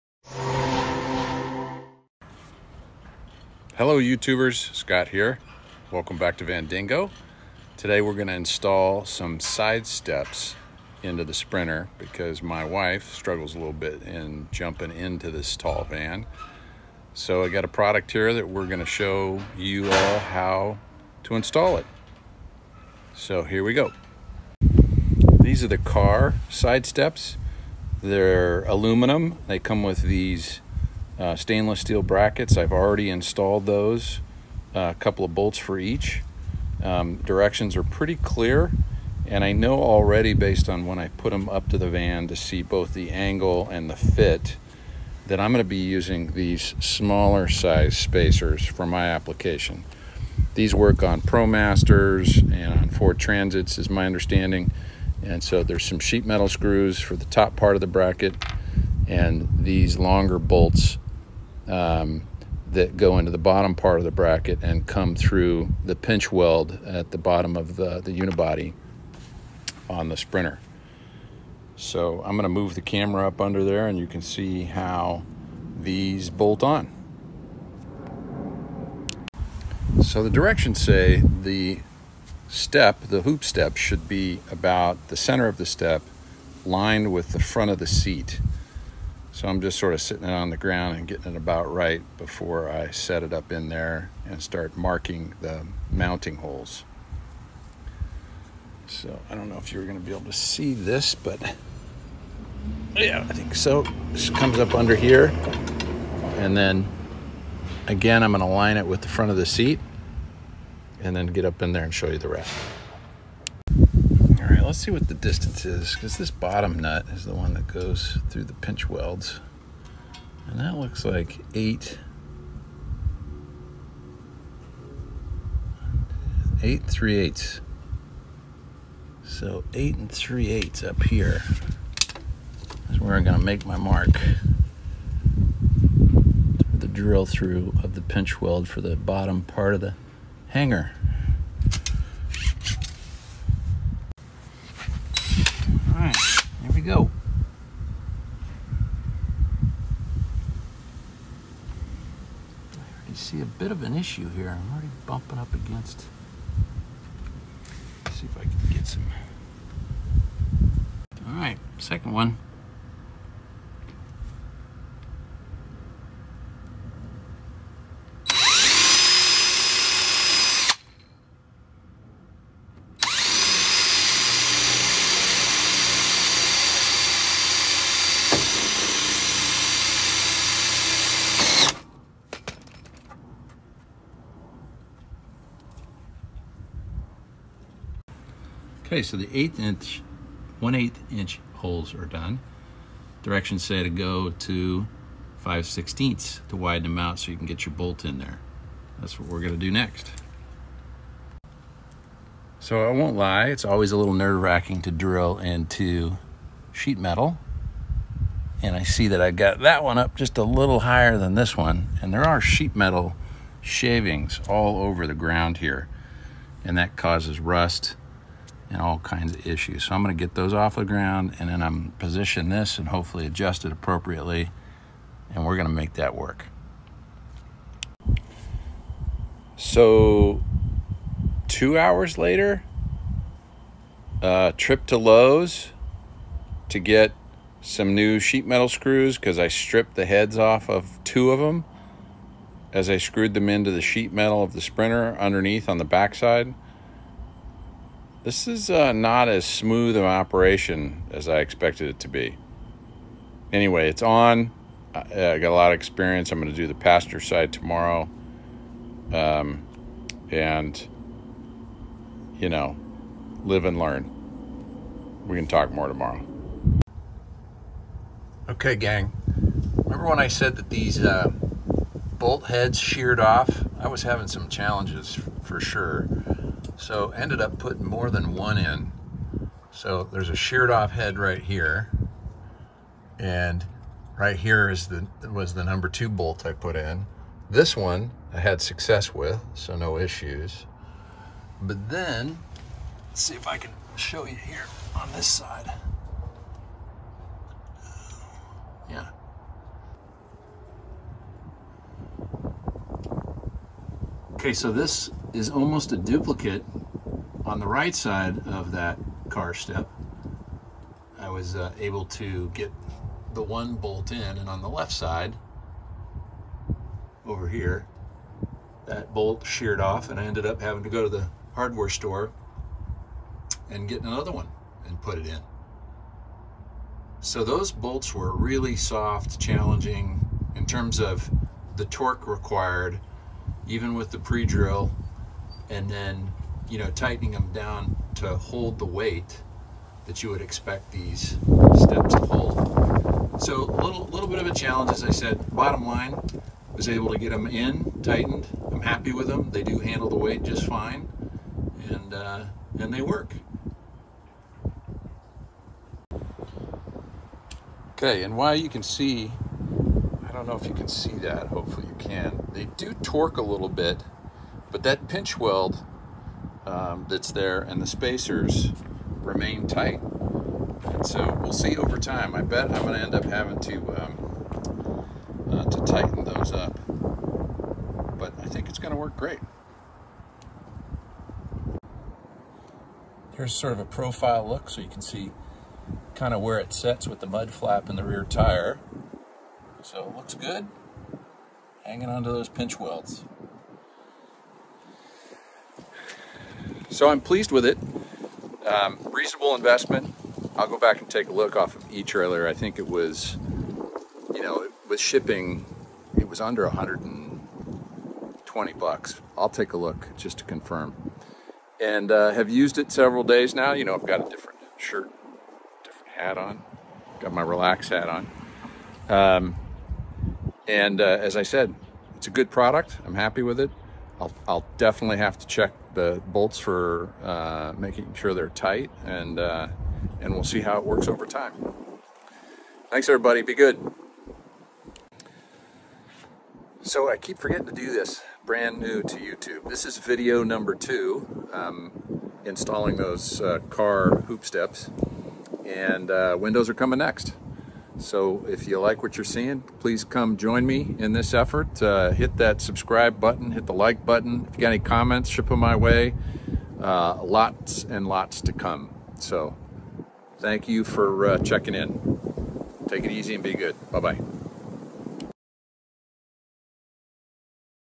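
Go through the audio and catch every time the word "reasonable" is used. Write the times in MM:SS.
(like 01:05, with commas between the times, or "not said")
06:39.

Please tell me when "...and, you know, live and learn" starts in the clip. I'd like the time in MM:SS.
04:20.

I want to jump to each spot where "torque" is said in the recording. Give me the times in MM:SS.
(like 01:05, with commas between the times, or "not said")
05:31, 06:02.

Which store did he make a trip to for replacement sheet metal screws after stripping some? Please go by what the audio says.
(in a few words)
Lowe's.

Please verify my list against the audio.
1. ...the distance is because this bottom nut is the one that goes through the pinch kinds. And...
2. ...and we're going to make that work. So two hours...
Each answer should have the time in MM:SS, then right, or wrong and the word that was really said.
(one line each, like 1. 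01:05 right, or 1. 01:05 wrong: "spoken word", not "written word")
1. 01:55 wrong: "welds", not "kinds"
2. 03:45 right.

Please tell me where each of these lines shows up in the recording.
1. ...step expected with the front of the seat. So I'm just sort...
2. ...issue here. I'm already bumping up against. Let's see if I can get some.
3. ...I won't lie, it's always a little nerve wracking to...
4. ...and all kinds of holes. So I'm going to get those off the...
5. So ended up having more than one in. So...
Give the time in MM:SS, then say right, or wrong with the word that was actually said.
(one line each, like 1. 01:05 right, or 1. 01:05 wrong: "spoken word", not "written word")
1. 01:25 wrong: "lined", not "expected"
2. 02:33 right
3. 03:22 right
4. 03:38 wrong: "issues", not "holes"
5. 04:36 wrong: "putting", not "having".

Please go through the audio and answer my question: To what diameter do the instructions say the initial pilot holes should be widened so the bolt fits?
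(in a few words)
5/16.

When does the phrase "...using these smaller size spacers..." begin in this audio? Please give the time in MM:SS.
00:45.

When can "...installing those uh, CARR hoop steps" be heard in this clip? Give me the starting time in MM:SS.
07:22.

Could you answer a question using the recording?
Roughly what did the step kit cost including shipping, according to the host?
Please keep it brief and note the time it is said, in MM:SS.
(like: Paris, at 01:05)
under $120, at 06:46.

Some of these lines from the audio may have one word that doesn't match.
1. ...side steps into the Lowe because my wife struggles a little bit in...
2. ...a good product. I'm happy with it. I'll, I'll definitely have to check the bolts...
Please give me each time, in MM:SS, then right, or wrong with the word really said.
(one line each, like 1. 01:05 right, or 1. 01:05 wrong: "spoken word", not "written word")
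1. 00:09 wrong: "Sprinter", not "Lowe"
2. 07:02 right.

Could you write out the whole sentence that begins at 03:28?
And I see that I got that one up just a little higher than this one.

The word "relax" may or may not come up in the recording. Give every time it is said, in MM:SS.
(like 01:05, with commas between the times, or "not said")
06:57.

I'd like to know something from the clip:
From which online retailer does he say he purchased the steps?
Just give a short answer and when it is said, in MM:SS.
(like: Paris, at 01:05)
eTrailer, at 06:41.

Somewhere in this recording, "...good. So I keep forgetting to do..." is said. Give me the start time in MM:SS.
07:13.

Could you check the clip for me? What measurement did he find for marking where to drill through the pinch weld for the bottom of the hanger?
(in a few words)
8 3/8.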